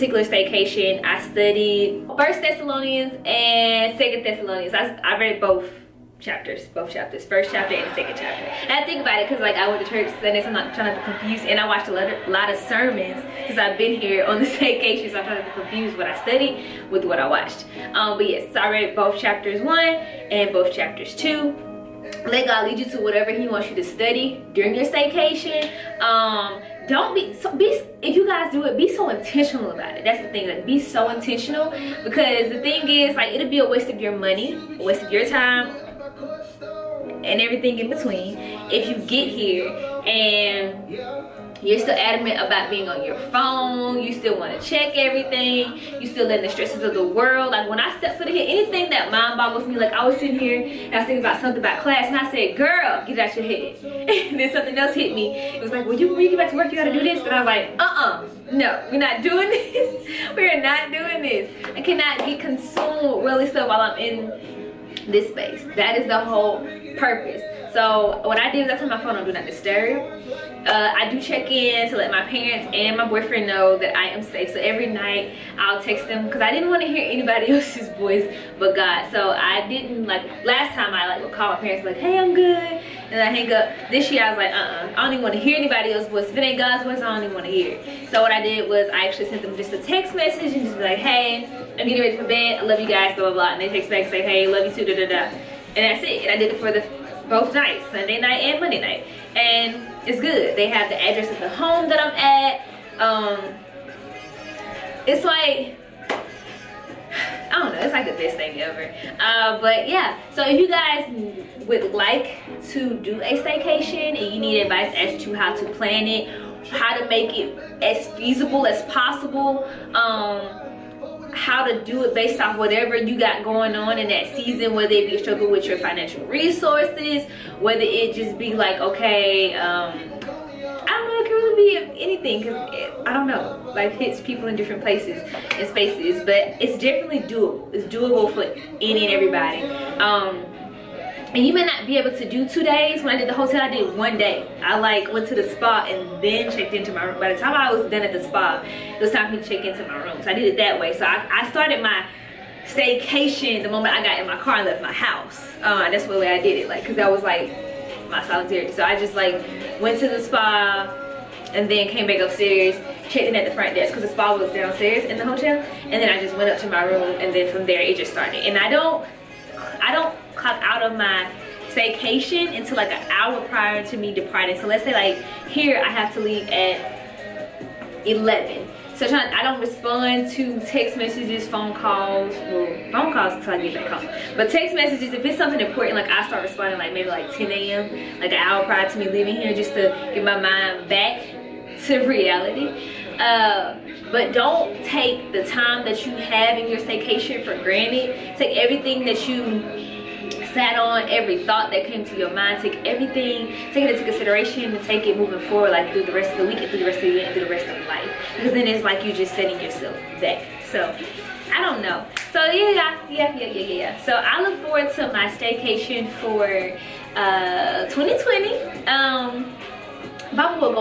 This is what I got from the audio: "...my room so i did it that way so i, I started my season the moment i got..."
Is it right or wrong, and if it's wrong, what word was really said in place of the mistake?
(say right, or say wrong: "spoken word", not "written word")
wrong: "staycation", not "season".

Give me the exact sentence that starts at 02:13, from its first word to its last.
Life hits people in different places and spaces, but it's definitely doable.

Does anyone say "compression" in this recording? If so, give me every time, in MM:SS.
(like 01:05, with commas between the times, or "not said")
not said.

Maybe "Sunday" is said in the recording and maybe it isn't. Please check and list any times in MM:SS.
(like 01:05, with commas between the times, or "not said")
00:10, 01:37.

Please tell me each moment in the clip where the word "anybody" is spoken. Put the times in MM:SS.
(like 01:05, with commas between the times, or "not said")
01:17, 01:25.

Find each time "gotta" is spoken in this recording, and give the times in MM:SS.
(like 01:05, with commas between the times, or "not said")
00:56.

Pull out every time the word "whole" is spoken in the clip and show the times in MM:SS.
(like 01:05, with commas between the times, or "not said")
01:06.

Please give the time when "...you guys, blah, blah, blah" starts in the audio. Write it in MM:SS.
01:32.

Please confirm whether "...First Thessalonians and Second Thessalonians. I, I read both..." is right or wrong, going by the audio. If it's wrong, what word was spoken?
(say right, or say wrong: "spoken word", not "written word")
right.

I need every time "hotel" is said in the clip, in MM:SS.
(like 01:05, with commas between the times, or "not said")
02:23, 02:45.